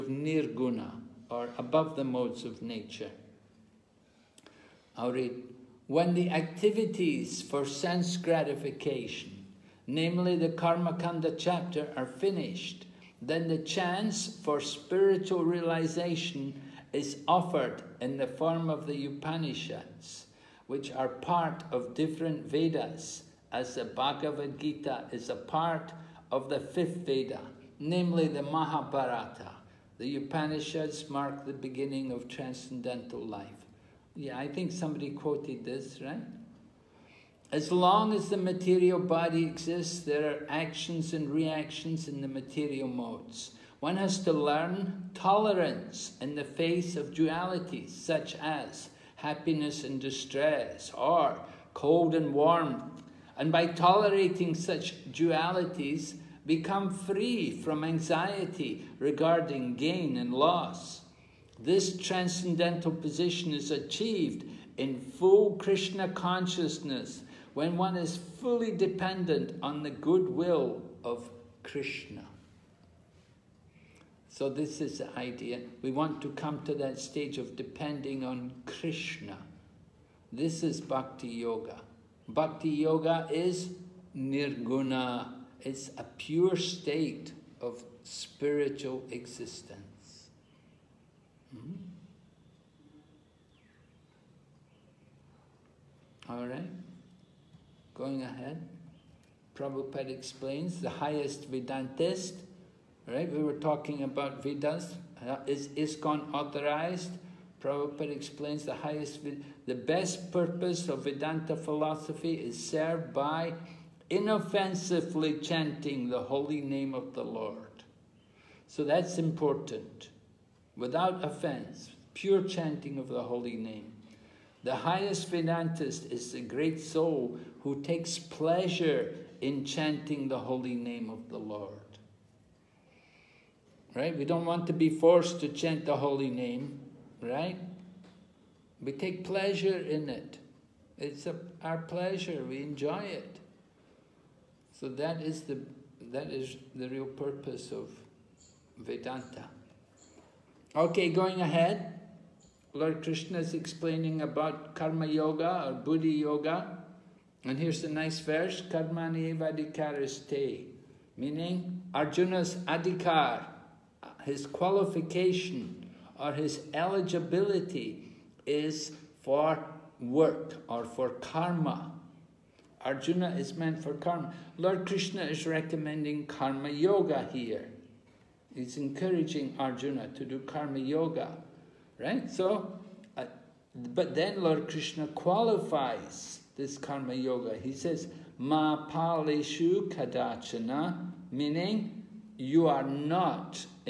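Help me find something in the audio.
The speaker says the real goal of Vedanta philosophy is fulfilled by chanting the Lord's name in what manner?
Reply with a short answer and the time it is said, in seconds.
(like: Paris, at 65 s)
Inoffensively, at 114 s.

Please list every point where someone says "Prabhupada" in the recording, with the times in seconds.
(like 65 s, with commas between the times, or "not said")
99 s, 107 s.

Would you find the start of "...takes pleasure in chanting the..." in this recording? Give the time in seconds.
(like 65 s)
127 s.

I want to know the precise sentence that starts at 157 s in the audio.
And here's a nice verse, Karmani Vadikaraste, meaning Arjuna's adhikar, his qualification or his eligibility is for work or for karma.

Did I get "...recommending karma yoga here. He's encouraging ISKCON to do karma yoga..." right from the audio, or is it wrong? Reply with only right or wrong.
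wrong.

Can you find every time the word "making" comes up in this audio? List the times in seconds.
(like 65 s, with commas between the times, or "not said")
not said.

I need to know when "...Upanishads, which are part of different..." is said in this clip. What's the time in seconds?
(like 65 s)
19 s.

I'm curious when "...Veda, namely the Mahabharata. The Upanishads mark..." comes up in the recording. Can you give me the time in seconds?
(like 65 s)
27 s.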